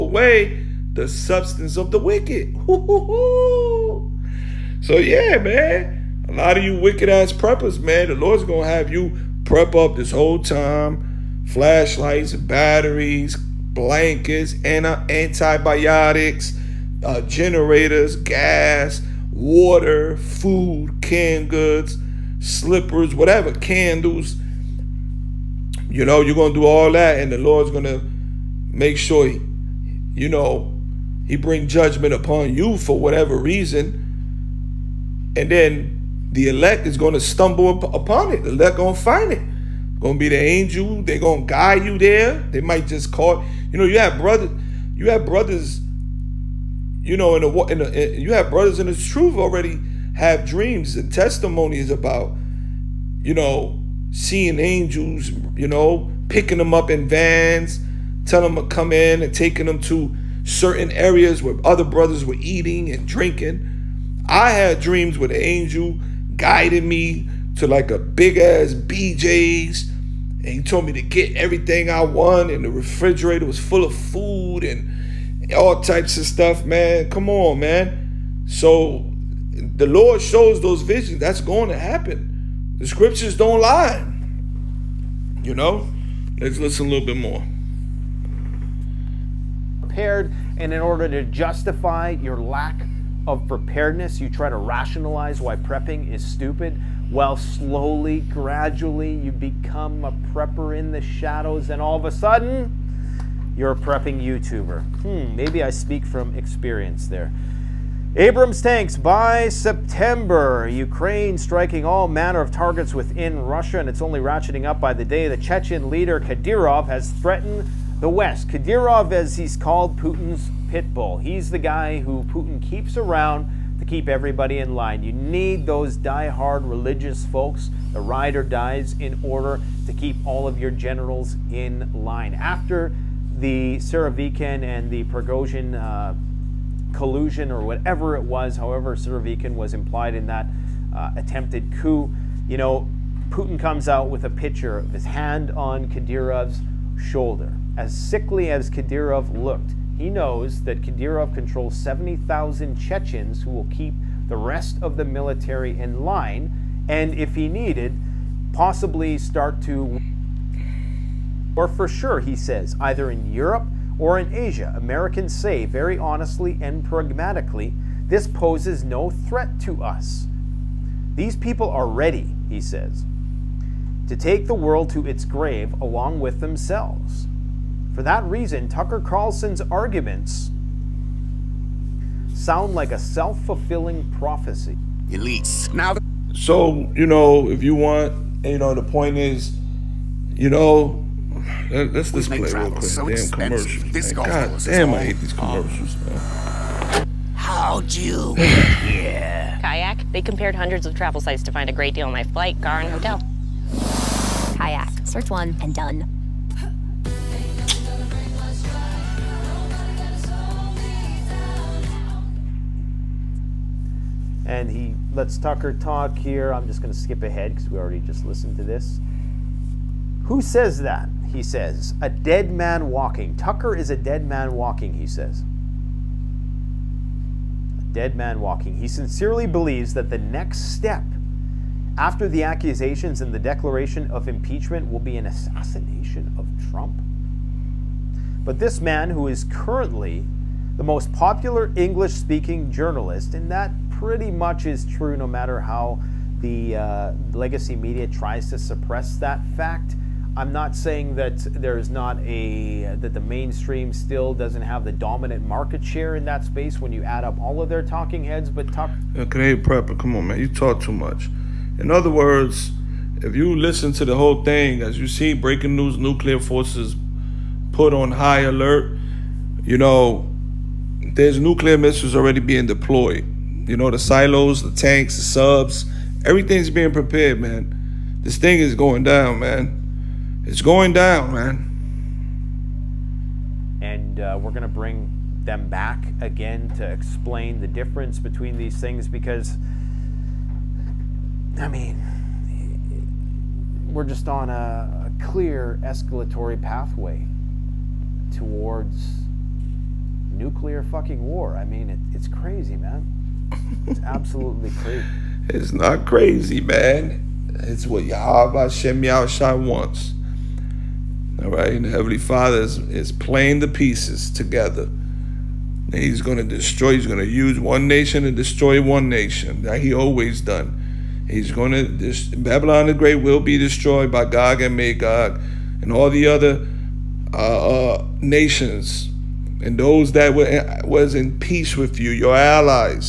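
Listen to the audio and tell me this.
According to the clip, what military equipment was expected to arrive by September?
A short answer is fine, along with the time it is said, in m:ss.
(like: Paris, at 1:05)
Abrams tanks, at 1:48.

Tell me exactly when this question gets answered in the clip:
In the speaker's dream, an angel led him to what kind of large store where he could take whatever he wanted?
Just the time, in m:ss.
1:08.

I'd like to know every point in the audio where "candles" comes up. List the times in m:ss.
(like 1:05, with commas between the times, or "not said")
0:23.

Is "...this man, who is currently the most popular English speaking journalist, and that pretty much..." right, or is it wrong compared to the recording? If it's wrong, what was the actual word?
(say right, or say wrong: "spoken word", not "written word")
right.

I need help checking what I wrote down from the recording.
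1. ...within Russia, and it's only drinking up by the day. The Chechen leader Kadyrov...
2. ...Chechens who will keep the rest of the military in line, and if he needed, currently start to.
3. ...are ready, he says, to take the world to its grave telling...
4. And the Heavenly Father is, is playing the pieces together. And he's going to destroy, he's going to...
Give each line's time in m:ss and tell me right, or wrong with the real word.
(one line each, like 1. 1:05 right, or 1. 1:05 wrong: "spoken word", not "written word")
1. 1:52 wrong: "ratcheting", not "drinking"
2. 2:32 wrong: "possibly", not "currently"
3. 2:51 wrong: "along", not "telling"
4. 5:11 right.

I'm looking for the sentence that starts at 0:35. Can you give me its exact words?
And then the elect is going to stumble up upon it.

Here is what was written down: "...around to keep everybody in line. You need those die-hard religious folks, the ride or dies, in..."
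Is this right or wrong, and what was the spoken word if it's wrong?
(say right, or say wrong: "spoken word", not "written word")
right.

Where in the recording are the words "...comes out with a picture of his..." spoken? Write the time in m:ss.
2:23.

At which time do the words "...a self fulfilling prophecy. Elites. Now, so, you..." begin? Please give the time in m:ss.
3:02.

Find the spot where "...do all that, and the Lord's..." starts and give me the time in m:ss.
0:26.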